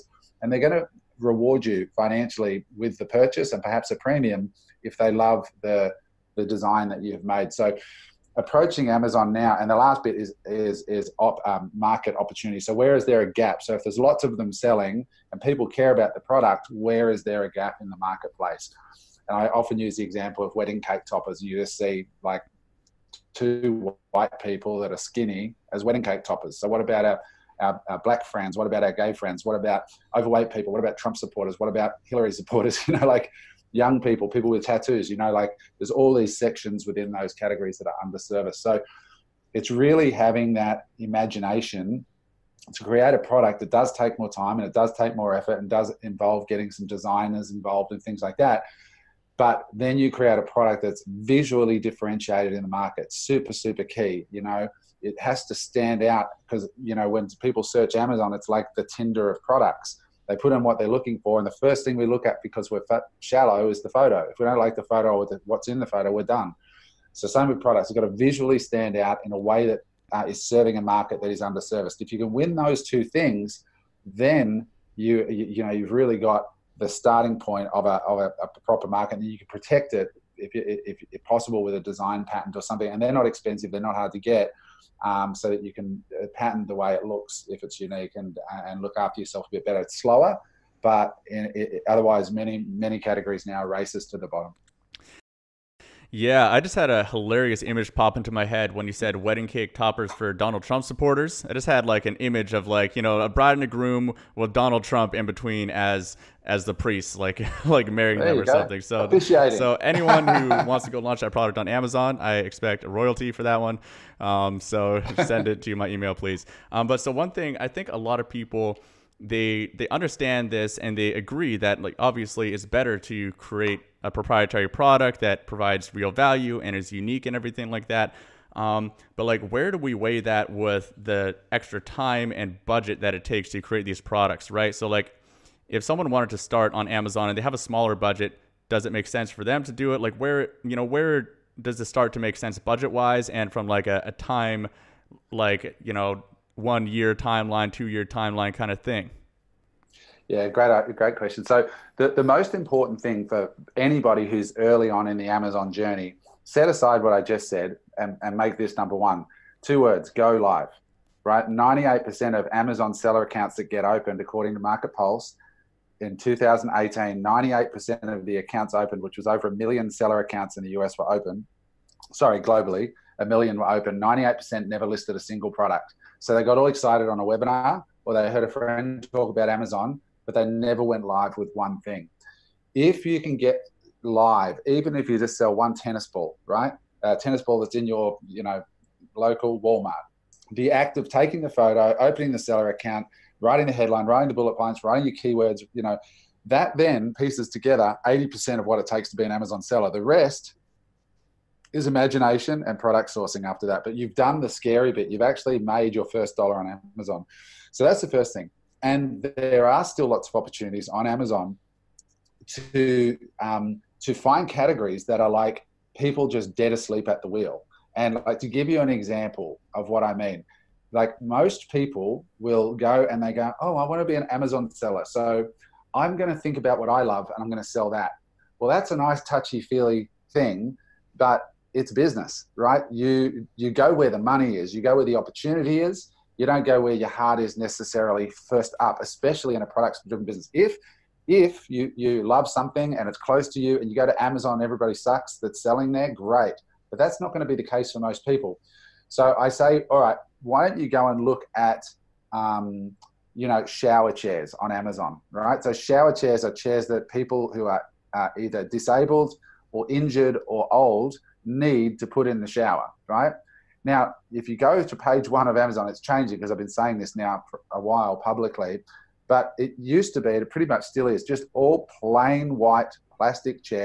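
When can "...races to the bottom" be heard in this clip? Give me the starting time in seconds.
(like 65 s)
93 s.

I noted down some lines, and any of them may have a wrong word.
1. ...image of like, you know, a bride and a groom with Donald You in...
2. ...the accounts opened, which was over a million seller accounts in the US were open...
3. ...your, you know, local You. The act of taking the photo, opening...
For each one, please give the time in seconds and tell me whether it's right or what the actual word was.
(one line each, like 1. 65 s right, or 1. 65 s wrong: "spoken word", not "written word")
1. 102 s wrong: "Trump", not "You"
2. 168 s right
3. 187 s wrong: "Walmart", not "You".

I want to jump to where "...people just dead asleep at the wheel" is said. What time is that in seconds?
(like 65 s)
215 s.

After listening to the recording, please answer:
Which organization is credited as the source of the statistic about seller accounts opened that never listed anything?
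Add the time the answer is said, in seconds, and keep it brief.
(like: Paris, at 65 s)
Market Pulse, at 164 s.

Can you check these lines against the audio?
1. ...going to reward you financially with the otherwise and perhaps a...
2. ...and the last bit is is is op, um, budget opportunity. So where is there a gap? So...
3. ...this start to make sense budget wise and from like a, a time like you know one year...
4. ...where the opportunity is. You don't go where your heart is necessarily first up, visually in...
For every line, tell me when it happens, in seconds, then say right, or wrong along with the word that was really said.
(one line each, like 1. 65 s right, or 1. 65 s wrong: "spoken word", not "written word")
1. 0 s wrong: "purchase", not "otherwise"
2. 9 s wrong: "market", not "budget"
3. 141 s right
4. 234 s wrong: "especially", not "visually".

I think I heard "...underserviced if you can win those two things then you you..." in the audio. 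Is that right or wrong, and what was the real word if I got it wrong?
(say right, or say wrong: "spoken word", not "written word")
right.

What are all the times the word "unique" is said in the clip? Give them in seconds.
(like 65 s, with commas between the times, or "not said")
87 s, 126 s.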